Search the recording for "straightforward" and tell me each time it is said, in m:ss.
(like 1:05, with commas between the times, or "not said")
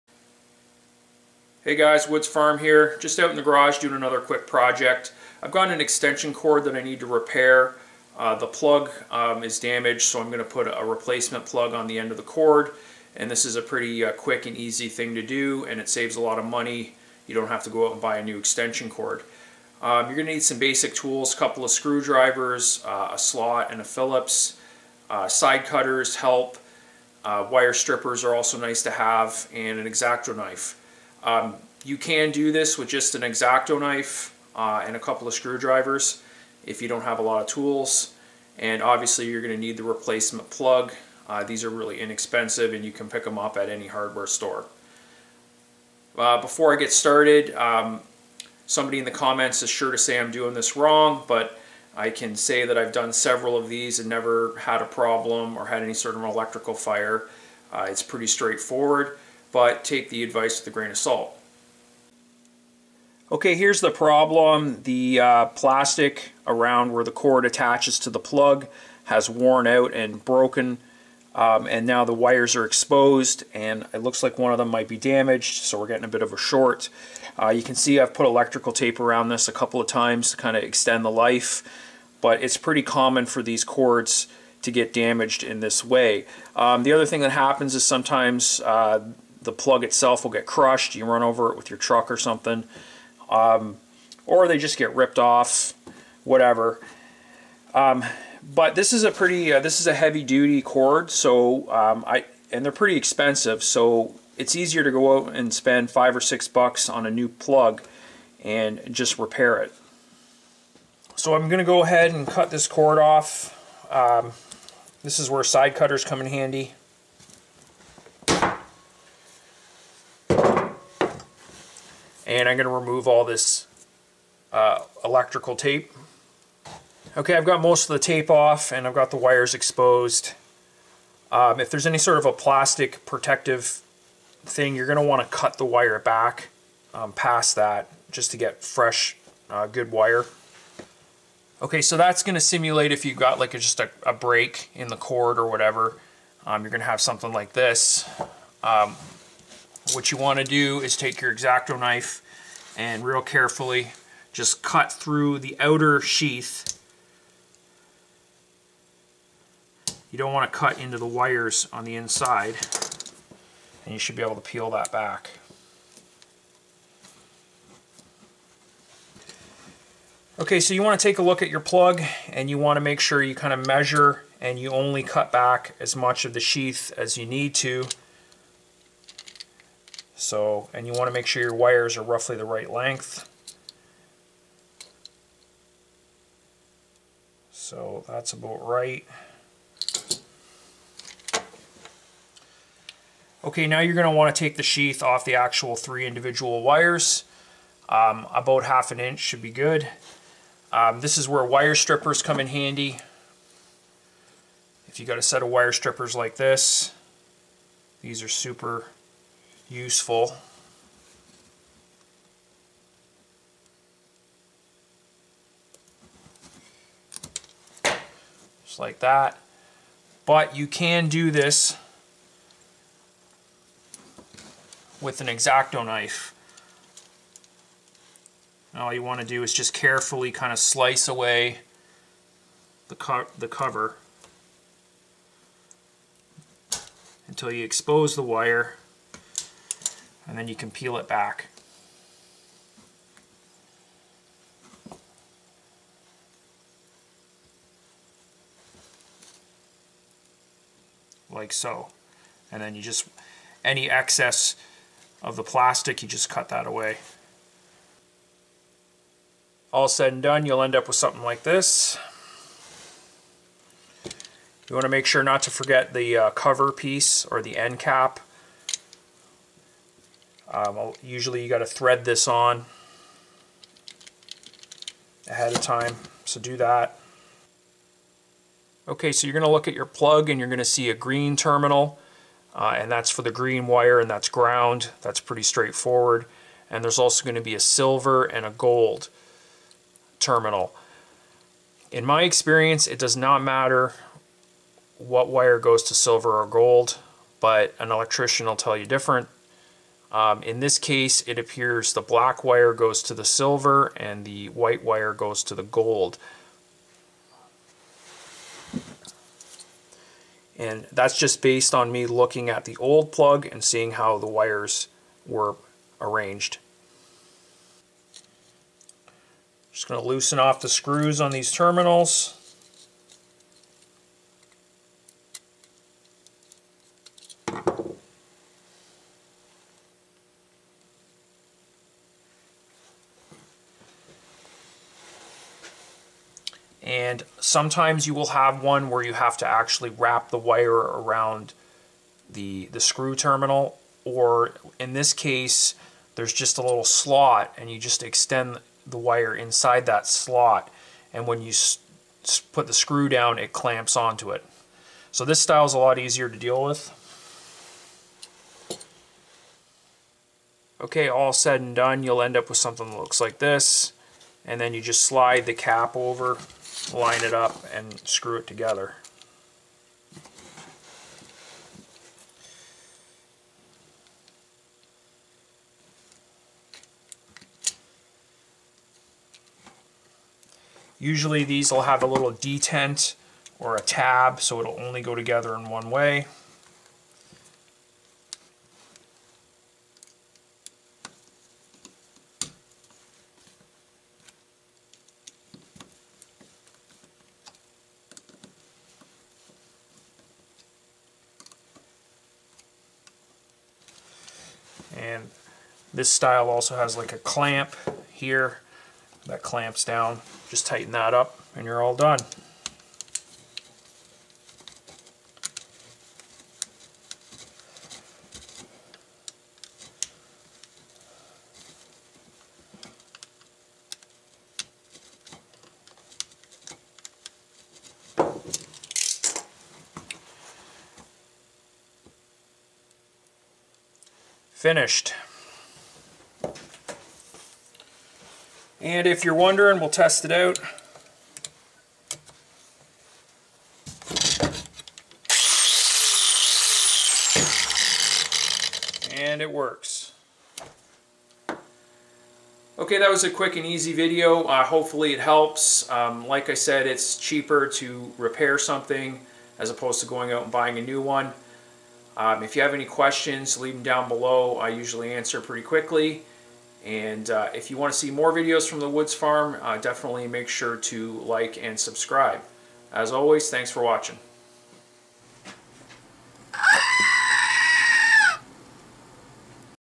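0:58, 4:45.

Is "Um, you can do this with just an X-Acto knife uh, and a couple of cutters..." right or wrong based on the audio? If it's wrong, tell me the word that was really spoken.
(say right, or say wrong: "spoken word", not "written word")
wrong: "screwdrivers", not "cutters".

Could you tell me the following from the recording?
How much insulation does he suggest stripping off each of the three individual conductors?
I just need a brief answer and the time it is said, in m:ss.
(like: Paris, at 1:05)
half an inch, at 3:18.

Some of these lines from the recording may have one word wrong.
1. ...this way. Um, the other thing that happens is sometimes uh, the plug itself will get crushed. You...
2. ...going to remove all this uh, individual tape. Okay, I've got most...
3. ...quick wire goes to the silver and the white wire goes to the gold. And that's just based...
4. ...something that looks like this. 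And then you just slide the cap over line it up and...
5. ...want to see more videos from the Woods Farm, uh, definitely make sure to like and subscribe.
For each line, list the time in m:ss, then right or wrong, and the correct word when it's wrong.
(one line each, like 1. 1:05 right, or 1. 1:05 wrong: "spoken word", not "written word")
1. 1:25 right
2. 2:02 wrong: "electrical", not "individual"
3. 5:02 wrong: "black", not "quick"
4. 6:02 right
5. 7:47 right.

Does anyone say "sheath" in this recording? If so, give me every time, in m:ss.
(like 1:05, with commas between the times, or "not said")
2:35, 2:56, 3:14.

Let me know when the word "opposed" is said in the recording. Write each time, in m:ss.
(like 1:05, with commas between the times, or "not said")
7:39.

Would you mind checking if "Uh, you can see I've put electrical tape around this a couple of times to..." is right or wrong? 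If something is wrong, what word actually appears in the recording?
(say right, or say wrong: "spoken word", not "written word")
right.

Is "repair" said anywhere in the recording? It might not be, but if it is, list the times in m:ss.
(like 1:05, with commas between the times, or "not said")
0:07, 1:49, 7:38.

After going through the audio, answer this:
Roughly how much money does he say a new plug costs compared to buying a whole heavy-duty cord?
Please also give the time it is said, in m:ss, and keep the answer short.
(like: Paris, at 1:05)
5 or 6 dollars, at 1:45.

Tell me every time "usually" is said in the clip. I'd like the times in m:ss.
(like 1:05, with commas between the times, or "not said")
4:31, 6:20, 7:44.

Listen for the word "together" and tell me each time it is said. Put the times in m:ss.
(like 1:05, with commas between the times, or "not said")
6:08, 6:25.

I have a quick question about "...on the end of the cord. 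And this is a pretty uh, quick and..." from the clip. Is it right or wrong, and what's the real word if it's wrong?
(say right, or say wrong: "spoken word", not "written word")
right.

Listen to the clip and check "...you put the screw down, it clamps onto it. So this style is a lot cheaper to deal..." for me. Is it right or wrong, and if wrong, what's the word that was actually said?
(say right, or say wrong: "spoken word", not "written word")
wrong: "easier", not "cheaper".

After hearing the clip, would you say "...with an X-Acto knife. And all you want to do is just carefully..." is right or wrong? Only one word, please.
right.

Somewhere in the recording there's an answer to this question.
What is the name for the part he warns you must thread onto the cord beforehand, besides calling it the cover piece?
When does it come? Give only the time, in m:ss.
4:27.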